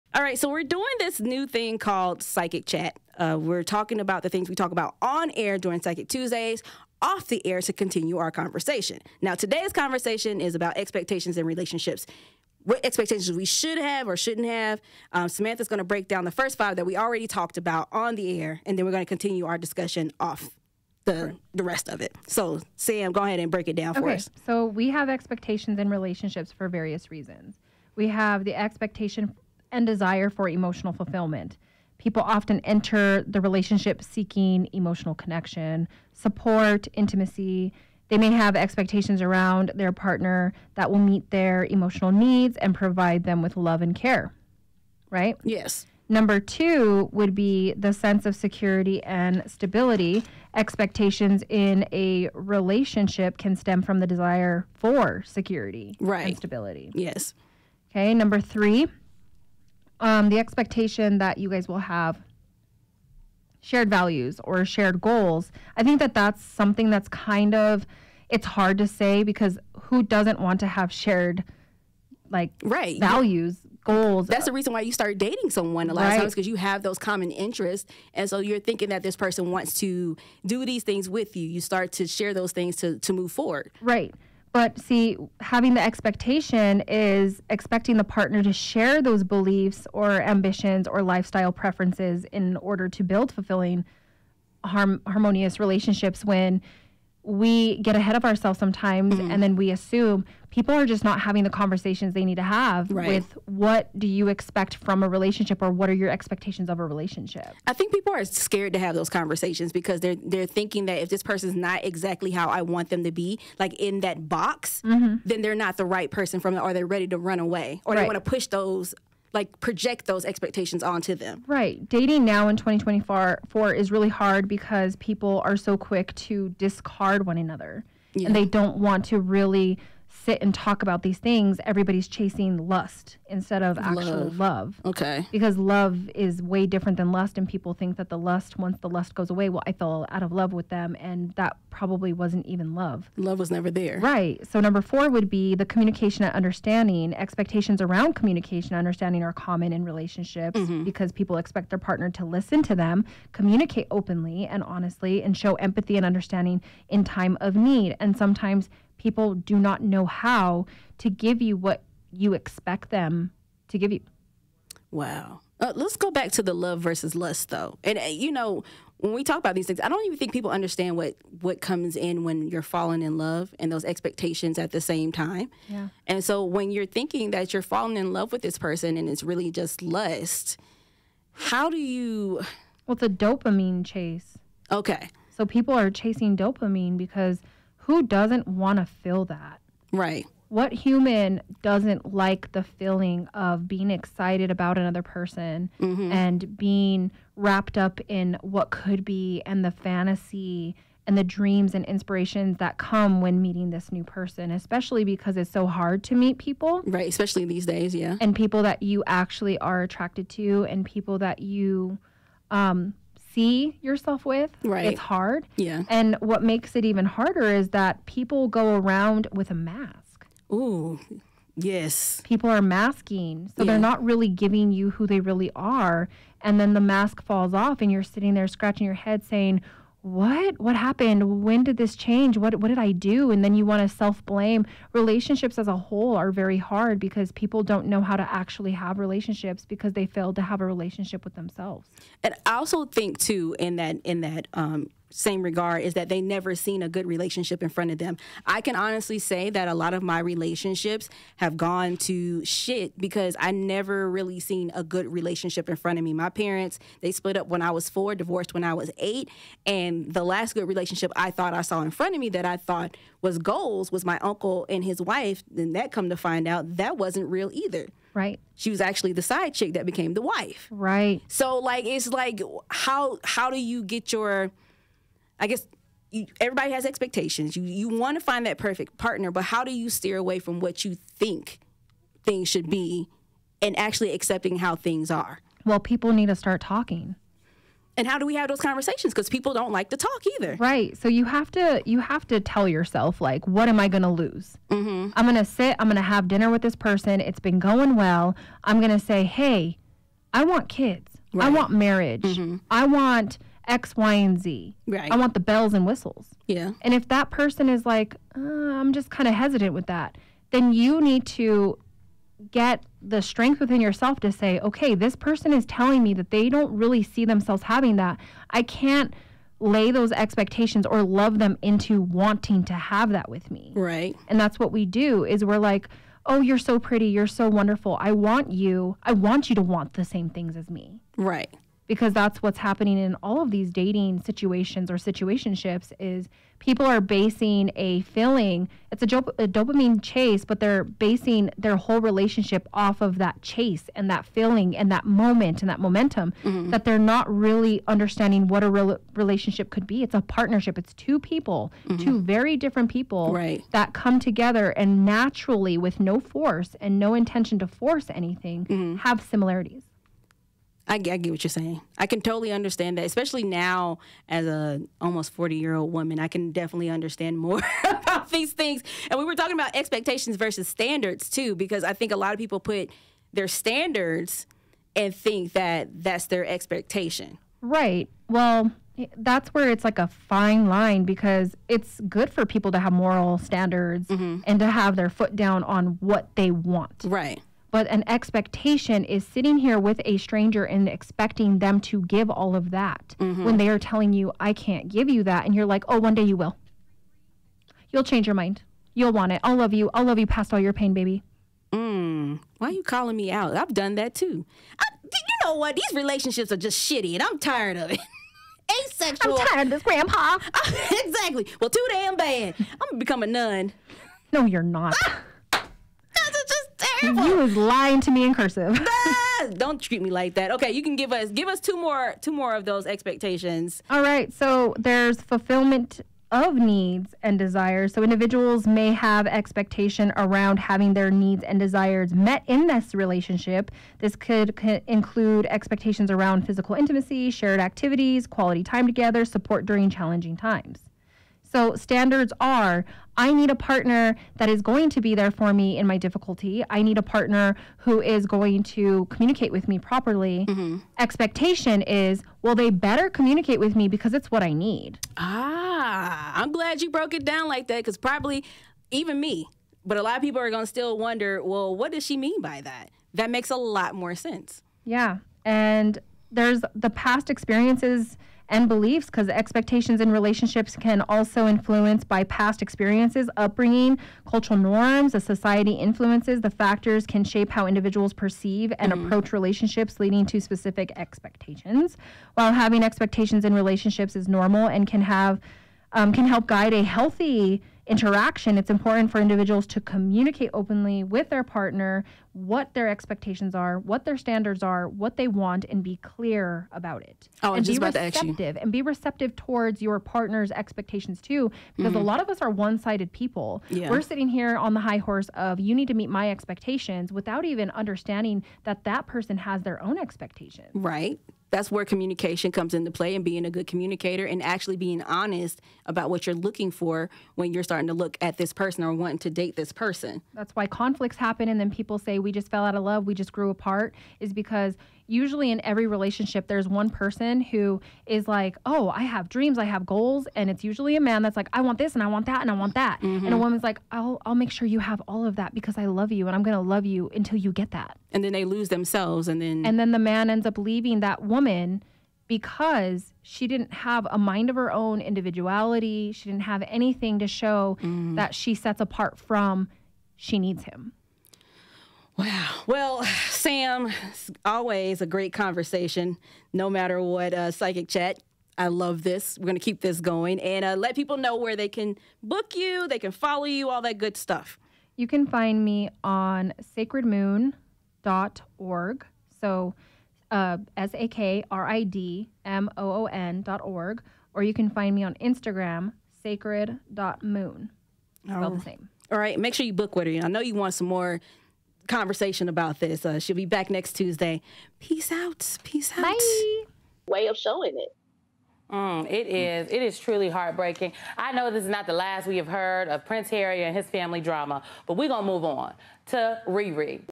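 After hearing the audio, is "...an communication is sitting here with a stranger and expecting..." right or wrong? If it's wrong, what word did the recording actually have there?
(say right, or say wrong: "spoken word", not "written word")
wrong: "expectation", not "communication".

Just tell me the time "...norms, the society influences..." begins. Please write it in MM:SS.
07:54.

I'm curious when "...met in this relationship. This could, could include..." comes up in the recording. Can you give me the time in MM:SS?
07:12.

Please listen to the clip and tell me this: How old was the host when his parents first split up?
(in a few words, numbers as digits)
4.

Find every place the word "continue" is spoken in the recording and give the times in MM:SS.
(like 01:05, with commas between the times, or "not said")
00:07, 00:19.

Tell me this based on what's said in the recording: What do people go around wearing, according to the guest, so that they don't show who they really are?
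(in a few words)
A mask.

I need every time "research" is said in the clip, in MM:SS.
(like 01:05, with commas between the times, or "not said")
not said.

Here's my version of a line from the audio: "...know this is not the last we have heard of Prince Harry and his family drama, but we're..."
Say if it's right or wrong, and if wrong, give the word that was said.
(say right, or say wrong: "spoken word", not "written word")
right.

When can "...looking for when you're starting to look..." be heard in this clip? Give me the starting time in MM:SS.
08:36.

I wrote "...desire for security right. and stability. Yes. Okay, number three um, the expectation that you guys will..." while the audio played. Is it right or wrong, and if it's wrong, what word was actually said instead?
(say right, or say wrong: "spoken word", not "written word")
right.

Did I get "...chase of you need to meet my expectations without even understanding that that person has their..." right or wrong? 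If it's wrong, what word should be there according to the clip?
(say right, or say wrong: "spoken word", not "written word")
wrong: "horse", not "chase".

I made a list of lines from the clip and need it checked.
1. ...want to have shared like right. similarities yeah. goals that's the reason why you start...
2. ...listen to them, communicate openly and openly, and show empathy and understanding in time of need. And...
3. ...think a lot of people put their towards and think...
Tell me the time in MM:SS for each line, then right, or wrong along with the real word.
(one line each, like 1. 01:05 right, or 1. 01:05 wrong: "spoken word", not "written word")
1. 01:10 wrong: "values", not "similarities"
2. 02:32 wrong: "honestly", not "openly"
3. 06:11 wrong: "standards", not "towards".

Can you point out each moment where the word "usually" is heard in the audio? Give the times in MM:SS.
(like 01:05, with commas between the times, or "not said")
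08:45, 08:50.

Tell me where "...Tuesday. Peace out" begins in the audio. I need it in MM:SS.
09:43.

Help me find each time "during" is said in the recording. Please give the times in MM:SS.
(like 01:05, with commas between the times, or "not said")
00:05, 07:19.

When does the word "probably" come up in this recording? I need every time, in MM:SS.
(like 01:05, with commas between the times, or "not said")
02:21, 07:37.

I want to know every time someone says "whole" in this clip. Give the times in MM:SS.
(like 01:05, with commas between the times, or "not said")
03:55, 05:41.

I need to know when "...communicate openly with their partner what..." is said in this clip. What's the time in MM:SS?
08:09.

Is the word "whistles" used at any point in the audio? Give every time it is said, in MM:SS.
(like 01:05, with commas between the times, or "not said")
05:05.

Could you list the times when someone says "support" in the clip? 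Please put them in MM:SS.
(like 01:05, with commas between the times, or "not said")
00:36, 07:19.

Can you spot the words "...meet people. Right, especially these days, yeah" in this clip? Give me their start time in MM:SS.
03:26.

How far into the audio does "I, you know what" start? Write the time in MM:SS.
06:44.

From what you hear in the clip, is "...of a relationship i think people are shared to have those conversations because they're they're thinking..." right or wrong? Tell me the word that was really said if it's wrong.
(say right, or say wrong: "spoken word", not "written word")
wrong: "scared", not "shared".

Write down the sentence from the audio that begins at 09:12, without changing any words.
Well, Sam, always a great conversation, no matter what uh, psychic chat.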